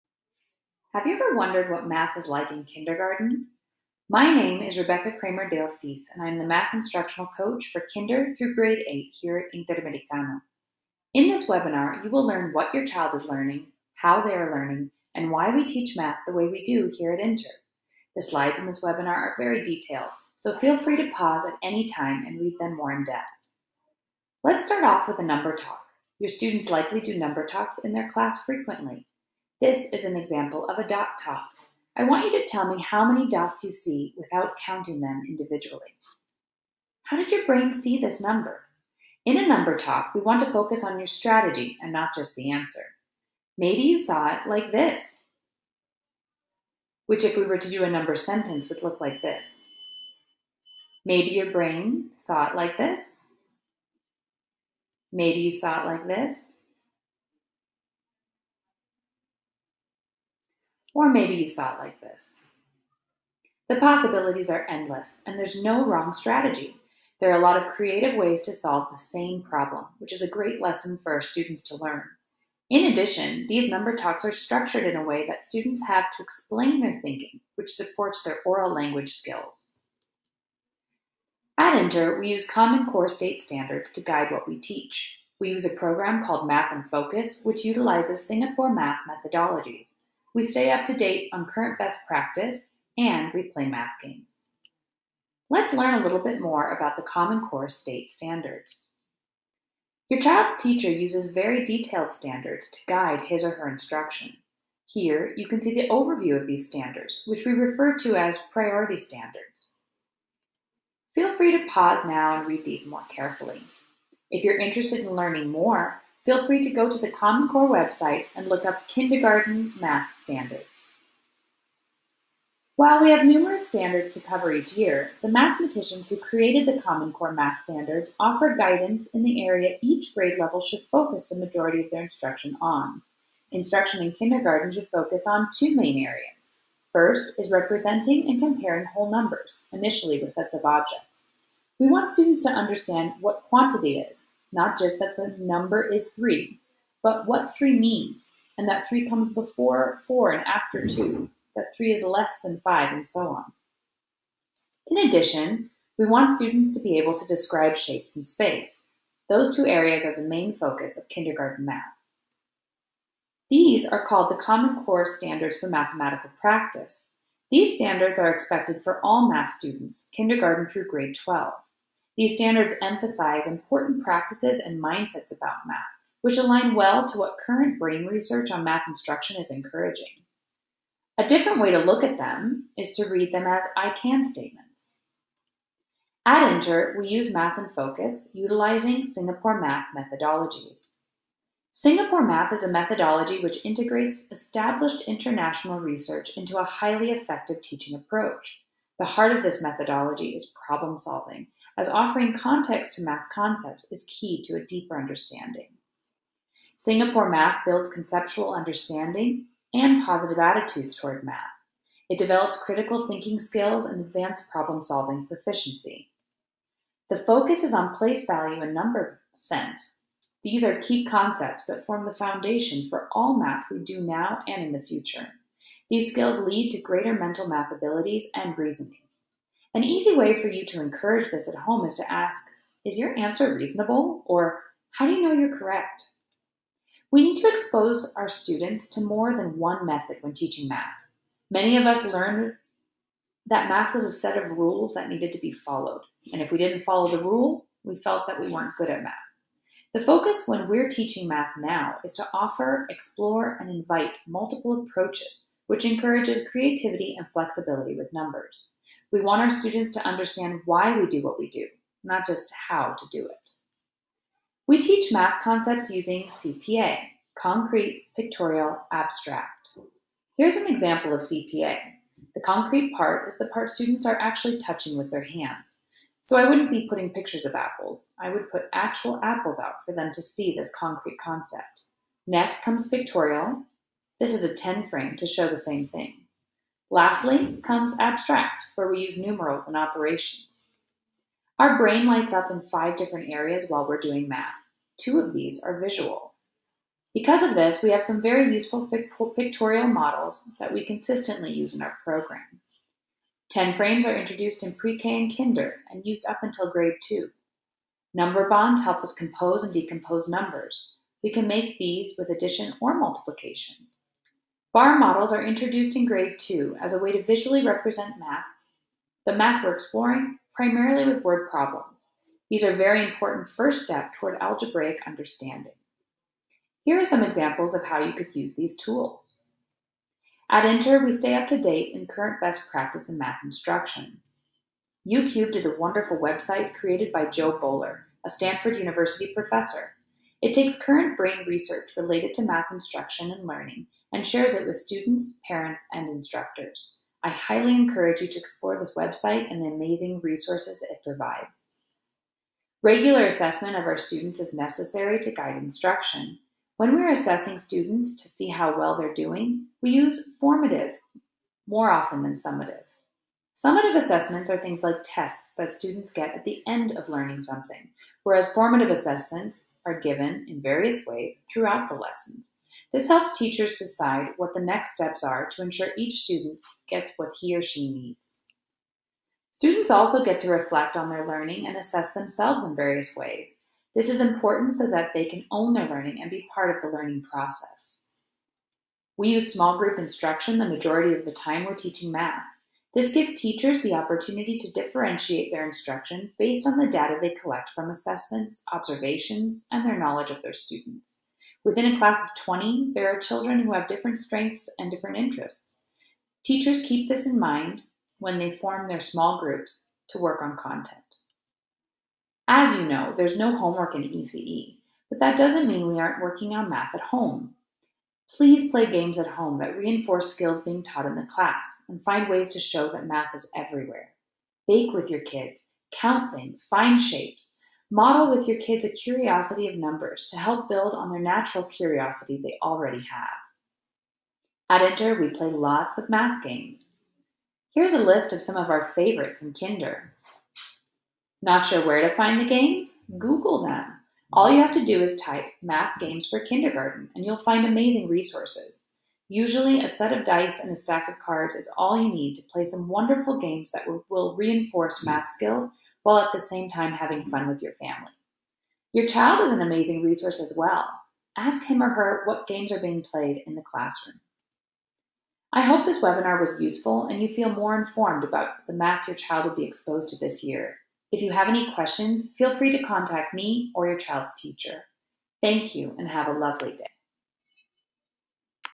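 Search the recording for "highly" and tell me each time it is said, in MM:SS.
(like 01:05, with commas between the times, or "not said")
03:16, 05:47.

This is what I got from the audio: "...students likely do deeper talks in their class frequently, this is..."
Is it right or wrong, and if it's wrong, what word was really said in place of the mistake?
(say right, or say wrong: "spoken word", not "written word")
wrong: "number", not "deeper".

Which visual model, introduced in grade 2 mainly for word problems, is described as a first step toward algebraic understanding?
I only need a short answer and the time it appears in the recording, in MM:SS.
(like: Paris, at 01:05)
Bar models, at 05:14.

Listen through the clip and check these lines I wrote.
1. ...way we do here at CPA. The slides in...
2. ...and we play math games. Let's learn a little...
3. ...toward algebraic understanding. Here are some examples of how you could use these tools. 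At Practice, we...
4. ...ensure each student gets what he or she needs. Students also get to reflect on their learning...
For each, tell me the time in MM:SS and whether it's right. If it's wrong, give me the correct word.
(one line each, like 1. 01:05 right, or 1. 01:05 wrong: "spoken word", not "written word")
1. 00:16 wrong: "Inter", not "CPA"
2. 01:32 right
3. 05:24 wrong: "Inter", not "Practice"
4. 06:15 right.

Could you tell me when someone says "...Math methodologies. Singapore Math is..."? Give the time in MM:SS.
03:09.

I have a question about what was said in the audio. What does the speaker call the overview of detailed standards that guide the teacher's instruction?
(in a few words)
priority standards.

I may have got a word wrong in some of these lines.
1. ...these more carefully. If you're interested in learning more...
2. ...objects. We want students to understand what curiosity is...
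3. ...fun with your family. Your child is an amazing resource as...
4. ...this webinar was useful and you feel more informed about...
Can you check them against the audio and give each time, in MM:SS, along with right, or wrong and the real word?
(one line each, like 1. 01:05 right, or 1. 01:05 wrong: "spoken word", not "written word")
1. 01:52 right
2. 02:20 wrong: "quantity", not "curiosity"
3. 07:37 right
4. 07:45 right.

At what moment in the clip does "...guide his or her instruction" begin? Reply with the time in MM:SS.
01:42.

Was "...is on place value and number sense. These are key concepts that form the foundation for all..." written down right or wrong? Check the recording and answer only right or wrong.
right.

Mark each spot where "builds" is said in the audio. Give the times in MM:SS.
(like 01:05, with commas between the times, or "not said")
03:27, 07:10.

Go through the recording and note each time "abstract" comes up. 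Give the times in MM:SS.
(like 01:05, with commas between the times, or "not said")
04:28, 04:48.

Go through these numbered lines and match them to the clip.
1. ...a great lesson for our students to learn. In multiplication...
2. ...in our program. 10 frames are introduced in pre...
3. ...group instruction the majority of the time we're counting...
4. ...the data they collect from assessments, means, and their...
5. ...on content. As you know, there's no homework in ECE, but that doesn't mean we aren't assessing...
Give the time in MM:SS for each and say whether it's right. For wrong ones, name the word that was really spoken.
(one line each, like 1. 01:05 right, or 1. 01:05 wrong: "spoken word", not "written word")
1. 01:10 wrong: "addition", not "multiplication"
2. 05:01 right
3. 06:29 wrong: "teaching", not "counting"
4. 06:36 wrong: "observations", not "means"
5. 06:50 wrong: "working", not "assessing".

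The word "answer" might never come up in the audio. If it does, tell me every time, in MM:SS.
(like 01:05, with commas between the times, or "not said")
00:42, 03:53.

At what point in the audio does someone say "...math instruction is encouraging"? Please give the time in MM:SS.
02:58.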